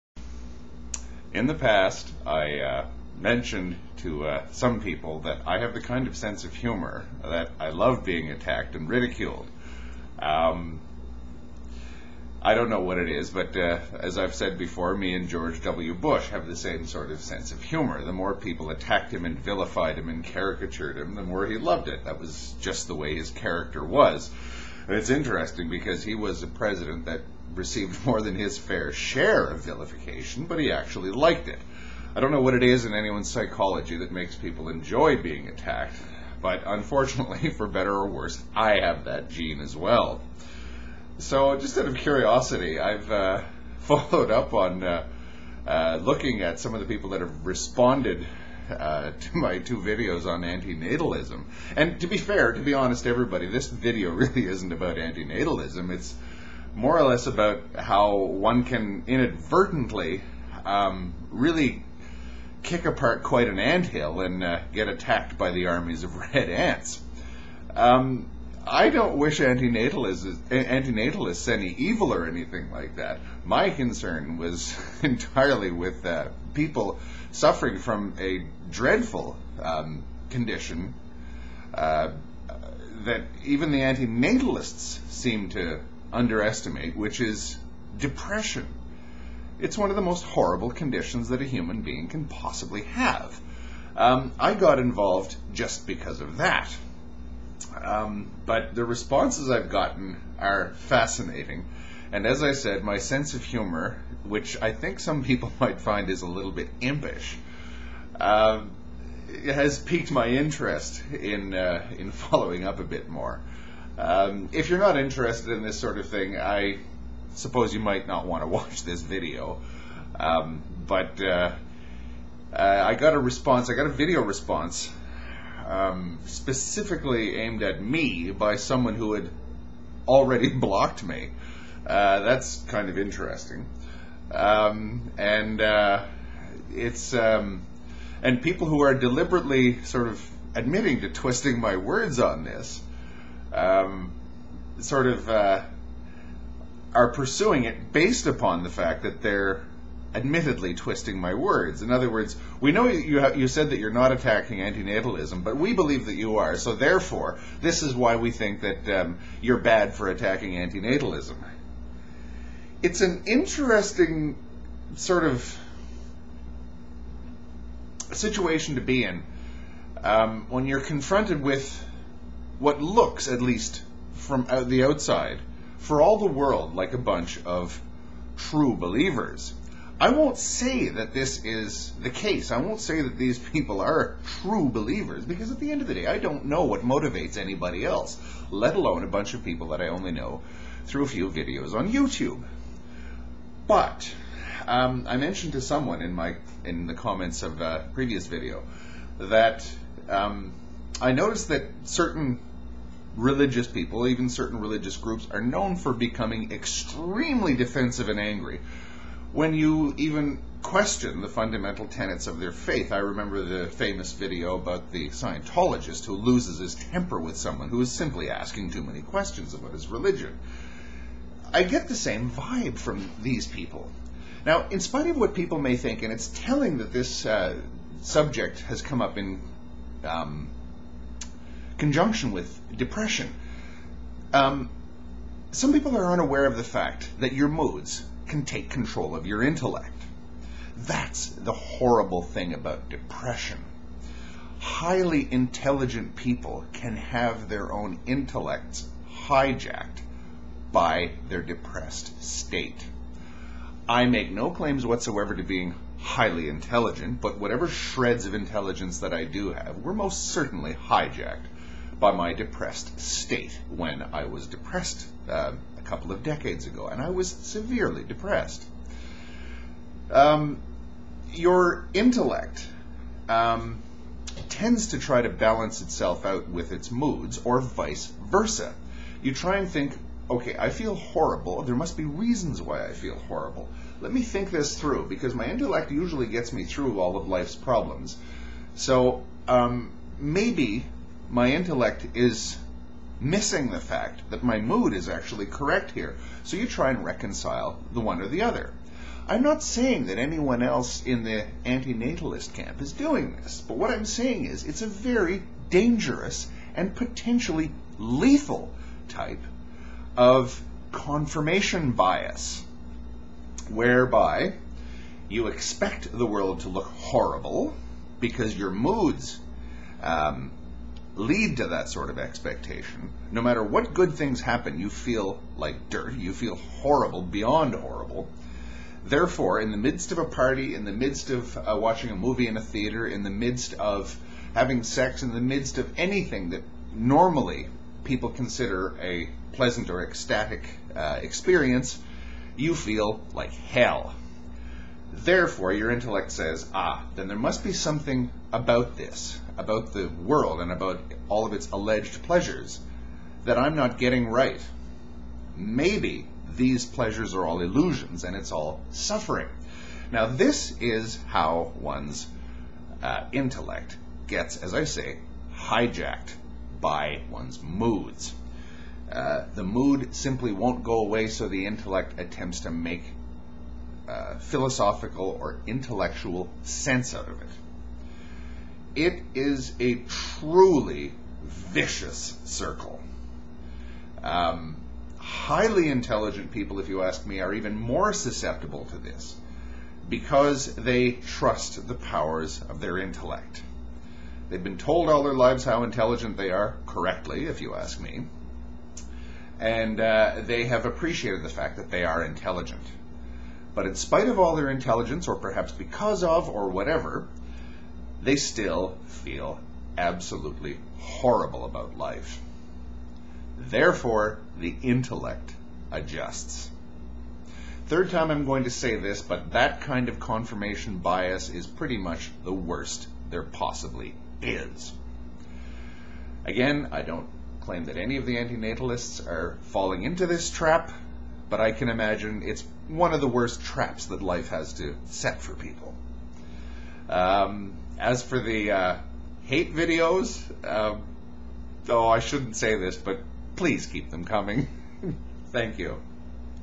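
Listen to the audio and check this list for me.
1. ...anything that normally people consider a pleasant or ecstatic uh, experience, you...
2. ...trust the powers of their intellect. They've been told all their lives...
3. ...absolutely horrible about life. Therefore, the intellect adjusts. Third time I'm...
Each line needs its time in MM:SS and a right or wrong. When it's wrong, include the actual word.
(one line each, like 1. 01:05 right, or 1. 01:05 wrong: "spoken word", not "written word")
1. 05:35 right
2. 06:31 right
3. 06:49 right.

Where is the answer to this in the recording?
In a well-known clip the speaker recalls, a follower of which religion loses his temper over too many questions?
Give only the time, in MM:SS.
03:35.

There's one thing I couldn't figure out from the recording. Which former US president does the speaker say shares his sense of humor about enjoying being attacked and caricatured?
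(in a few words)
George W. Bush.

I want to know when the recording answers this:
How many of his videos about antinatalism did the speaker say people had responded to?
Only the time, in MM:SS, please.
00:49.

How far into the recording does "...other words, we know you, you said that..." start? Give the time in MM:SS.
02:31.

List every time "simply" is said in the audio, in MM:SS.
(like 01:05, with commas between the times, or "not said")
03:37, 06:10.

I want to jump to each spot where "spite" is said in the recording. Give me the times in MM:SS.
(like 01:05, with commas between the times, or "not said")
03:44, 06:43.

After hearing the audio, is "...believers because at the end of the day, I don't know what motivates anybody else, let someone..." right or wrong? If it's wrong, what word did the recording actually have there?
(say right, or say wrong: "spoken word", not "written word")
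wrong: "alone", not "someone".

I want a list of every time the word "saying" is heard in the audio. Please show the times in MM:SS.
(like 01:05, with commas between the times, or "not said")
04:59, 05:04.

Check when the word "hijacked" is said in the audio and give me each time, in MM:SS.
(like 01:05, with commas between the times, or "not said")
04:09, 04:20, 06:05.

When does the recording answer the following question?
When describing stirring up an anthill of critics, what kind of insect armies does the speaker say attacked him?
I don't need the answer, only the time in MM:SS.
01:06.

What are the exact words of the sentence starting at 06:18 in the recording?
It is a truly vicious circle.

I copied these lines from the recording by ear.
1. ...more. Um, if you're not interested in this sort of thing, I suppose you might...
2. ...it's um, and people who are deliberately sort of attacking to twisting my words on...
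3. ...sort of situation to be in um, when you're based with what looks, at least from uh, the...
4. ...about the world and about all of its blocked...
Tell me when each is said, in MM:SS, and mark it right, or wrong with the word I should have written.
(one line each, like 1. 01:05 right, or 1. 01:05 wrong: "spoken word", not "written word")
1. 01:53 right
2. 02:16 wrong: "admitting", not "attacking"
3. 02:44 wrong: "confronted", not "based"
4. 05:49 wrong: "alleged", not "blocked".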